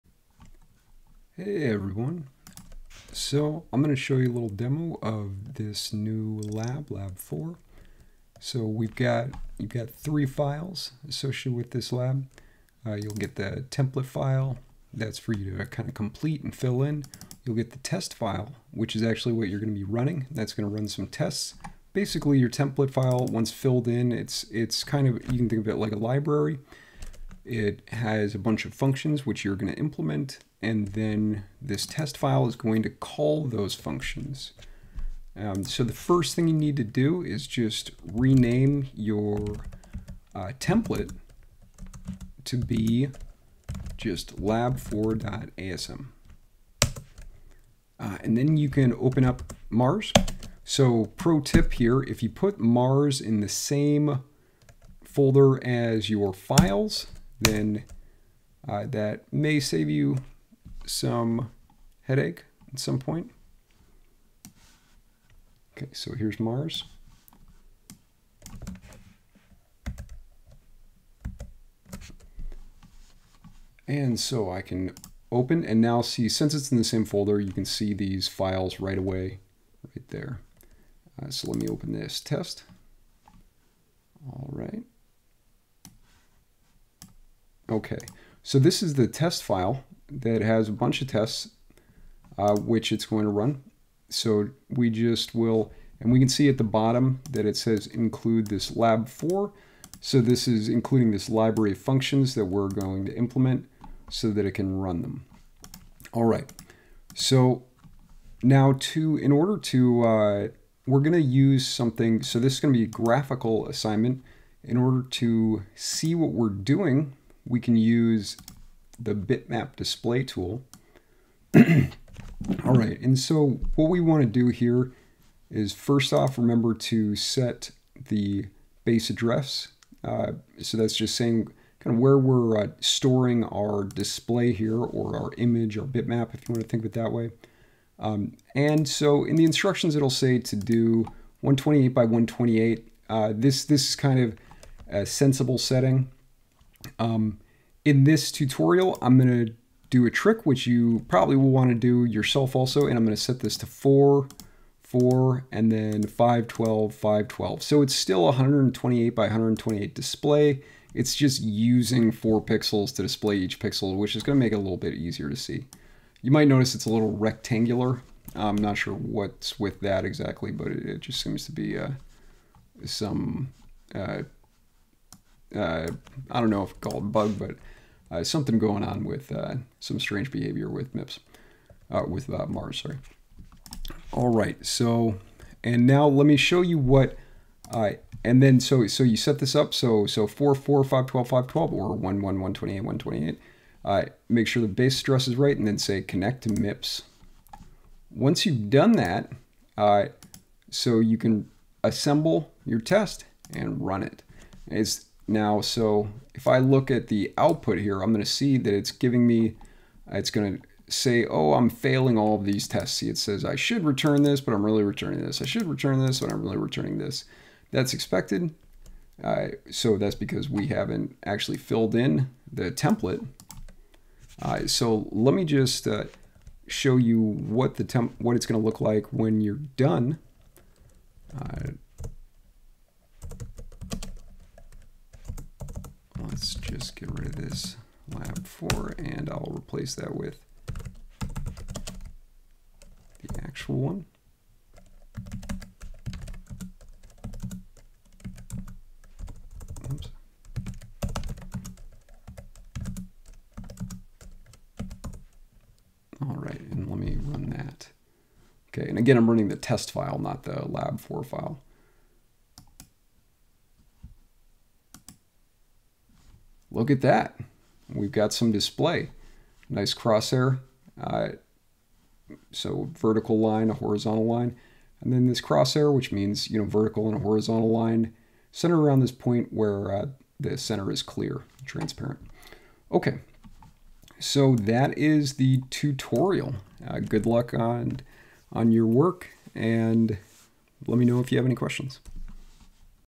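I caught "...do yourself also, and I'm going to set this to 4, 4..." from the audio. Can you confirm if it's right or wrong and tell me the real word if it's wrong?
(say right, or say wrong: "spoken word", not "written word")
right.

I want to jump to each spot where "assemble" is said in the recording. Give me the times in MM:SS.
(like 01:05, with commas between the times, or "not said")
03:21.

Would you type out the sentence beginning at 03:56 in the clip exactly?
let's just get rid of this lab 4 and I'll replace that with the actual one.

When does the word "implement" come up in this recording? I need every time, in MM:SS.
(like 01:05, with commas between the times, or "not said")
00:29, 01:43.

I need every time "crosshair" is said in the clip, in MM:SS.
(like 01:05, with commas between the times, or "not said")
04:29, 04:35.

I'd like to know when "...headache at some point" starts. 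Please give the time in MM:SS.
01:02.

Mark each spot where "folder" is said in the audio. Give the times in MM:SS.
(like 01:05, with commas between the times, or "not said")
00:55, 01:17.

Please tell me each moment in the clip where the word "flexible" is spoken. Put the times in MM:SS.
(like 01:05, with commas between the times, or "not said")
not said.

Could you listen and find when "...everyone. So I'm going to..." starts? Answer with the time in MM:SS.
00:01.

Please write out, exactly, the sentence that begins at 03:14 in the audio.
make sure the base address is right, and then say connect to MIPS.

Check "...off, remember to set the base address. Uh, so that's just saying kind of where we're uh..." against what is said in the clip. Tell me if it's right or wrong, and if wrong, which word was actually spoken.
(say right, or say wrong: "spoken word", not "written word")
right.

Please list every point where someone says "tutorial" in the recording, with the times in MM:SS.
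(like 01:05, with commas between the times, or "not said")
02:28, 04:45.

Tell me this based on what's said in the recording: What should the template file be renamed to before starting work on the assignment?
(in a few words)
lab4.asm.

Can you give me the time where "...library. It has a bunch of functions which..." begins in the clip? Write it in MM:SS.
00:25.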